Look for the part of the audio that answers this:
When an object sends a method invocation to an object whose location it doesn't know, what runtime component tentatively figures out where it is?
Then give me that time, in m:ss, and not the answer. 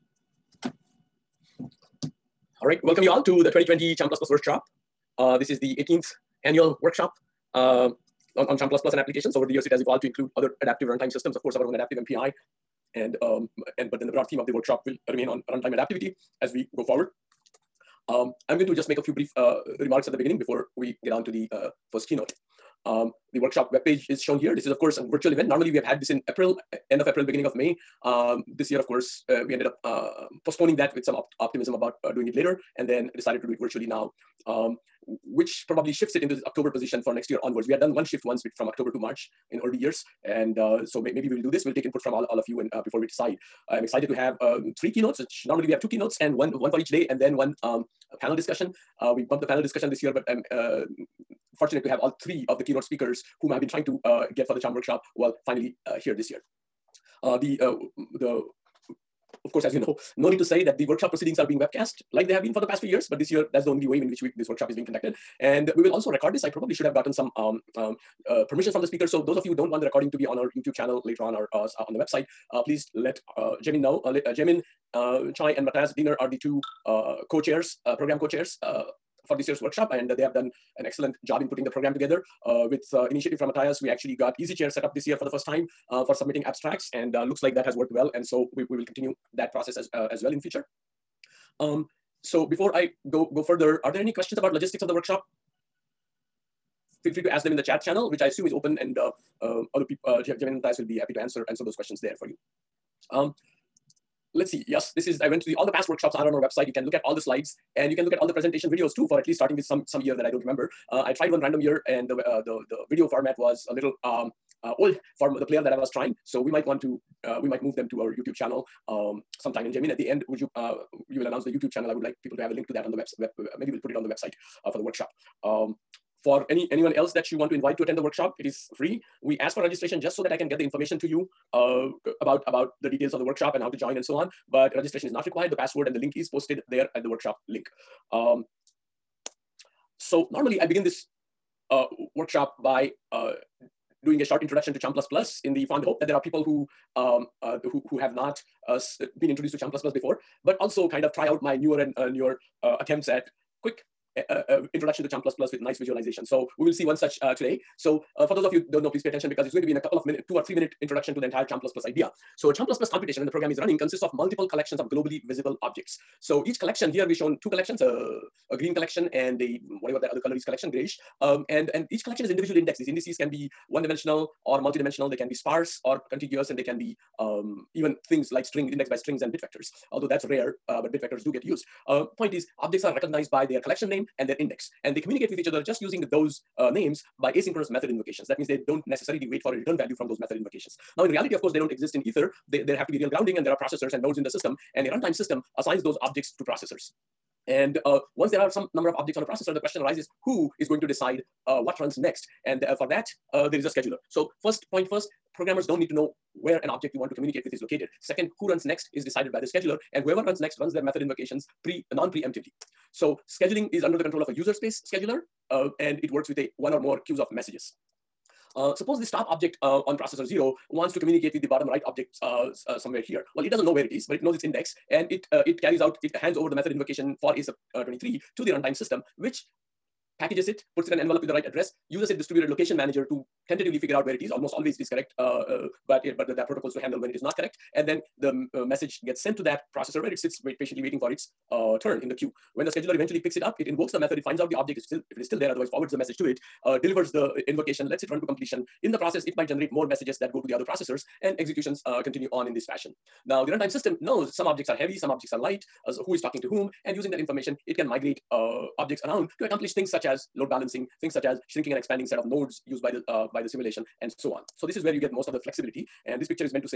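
3:52.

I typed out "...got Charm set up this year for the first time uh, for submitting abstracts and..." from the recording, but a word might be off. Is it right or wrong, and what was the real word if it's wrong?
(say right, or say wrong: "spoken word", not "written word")
wrong: "EasyChair", not "Charm".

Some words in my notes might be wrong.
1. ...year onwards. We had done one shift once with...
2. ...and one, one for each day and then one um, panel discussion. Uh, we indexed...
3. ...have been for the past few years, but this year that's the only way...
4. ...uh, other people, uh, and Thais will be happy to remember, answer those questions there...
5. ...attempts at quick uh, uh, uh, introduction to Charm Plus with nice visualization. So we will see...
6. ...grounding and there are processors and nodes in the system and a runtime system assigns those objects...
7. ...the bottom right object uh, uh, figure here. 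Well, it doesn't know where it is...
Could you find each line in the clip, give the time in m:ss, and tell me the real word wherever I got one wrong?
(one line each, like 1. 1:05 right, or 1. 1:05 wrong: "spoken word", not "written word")
1. 0:37 right
2. 0:46 wrong: "bumped", not "indexed"
3. 1:02 right
4. 1:39 wrong: "answer", not "remember"
5. 2:32 wrong: "Plus", not "Charm"
6. 3:13 right
7. 3:41 wrong: "somewhere", not "figure".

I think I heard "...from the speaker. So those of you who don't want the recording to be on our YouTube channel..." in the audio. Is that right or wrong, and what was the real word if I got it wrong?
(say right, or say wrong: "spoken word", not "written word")
right.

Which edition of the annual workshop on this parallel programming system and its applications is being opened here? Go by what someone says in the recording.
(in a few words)
18th.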